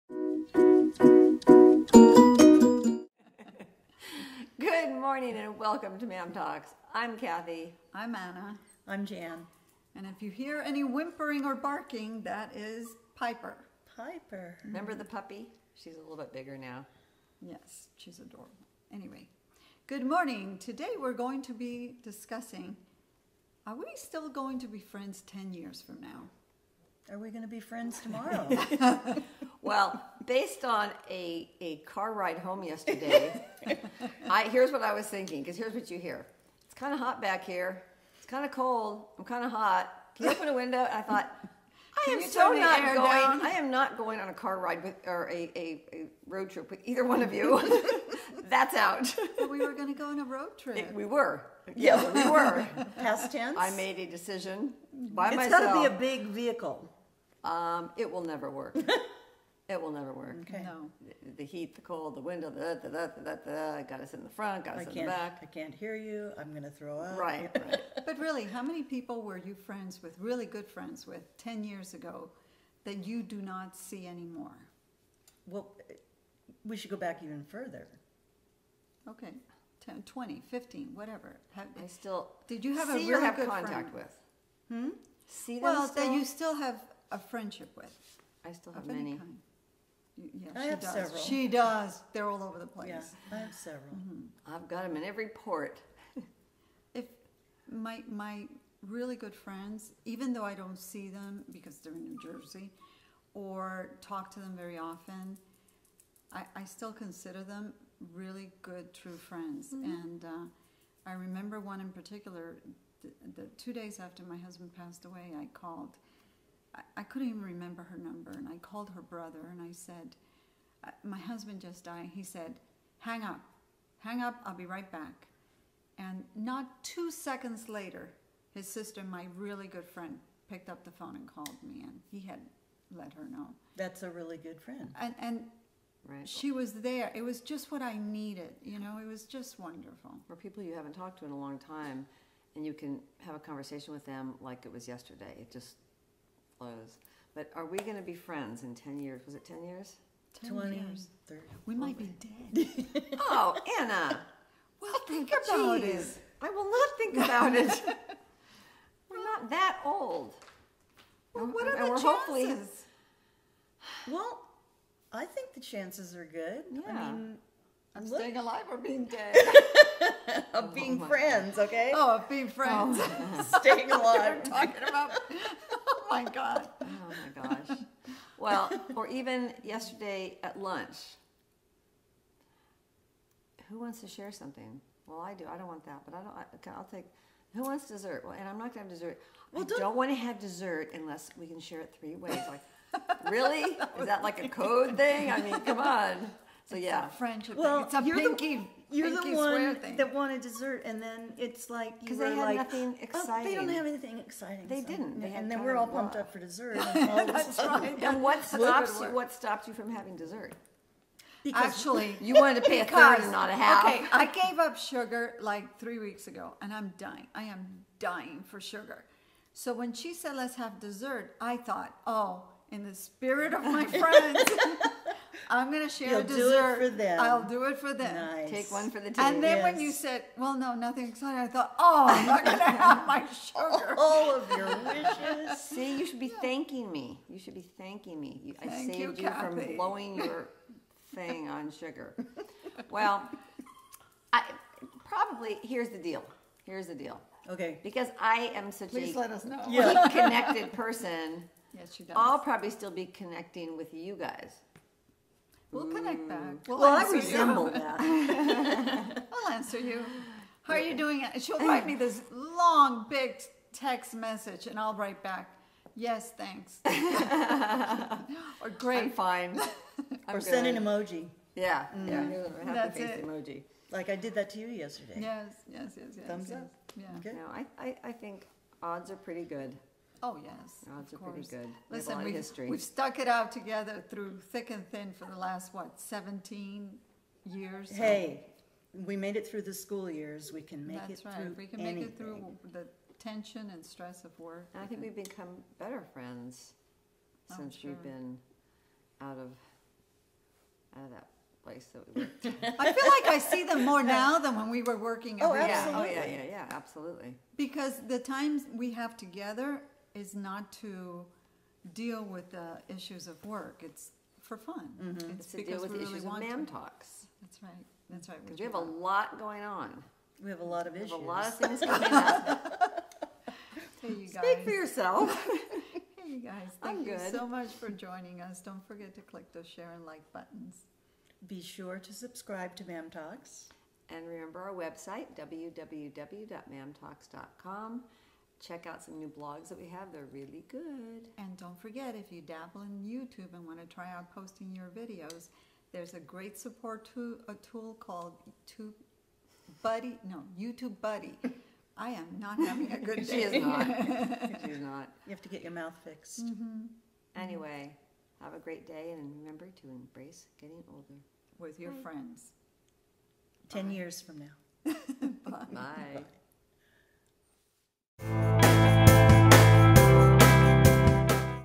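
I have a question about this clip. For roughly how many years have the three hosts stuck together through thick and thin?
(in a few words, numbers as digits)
17.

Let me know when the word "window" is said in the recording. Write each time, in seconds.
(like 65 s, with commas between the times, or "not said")
40 s, 62 s.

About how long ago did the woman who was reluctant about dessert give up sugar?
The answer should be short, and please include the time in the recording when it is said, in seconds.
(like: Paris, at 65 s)
3 weeks, at 215 s.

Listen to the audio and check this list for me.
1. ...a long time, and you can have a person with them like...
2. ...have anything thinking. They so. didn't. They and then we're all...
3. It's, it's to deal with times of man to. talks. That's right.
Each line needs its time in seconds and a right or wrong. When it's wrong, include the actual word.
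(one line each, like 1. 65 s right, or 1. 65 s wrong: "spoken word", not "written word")
1. 141 s wrong: "conversation", not "person"
2. 203 s wrong: "exciting", not "thinking"
3. 315 s wrong: "issues", not "times".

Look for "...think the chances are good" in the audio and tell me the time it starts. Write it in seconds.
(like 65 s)
165 s.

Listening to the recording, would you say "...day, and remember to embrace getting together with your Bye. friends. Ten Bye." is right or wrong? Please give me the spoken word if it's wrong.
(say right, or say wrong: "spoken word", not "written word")
wrong: "older", not "together".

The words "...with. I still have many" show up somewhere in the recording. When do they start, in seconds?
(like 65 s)
87 s.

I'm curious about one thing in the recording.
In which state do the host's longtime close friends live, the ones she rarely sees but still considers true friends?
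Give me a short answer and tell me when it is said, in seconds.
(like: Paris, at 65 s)
New Jersey, at 102 s.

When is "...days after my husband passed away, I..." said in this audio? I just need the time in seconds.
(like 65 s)
113 s.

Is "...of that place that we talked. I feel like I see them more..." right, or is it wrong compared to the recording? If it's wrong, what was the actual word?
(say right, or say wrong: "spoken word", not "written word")
wrong: "worked", not "talked".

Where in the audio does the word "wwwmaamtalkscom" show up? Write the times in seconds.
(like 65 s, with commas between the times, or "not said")
335 s.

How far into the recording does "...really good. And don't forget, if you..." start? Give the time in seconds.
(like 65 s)
340 s.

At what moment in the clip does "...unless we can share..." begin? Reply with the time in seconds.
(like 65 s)
190 s.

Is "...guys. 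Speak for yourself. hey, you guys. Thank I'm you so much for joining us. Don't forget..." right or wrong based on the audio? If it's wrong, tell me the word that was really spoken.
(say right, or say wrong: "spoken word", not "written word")
right.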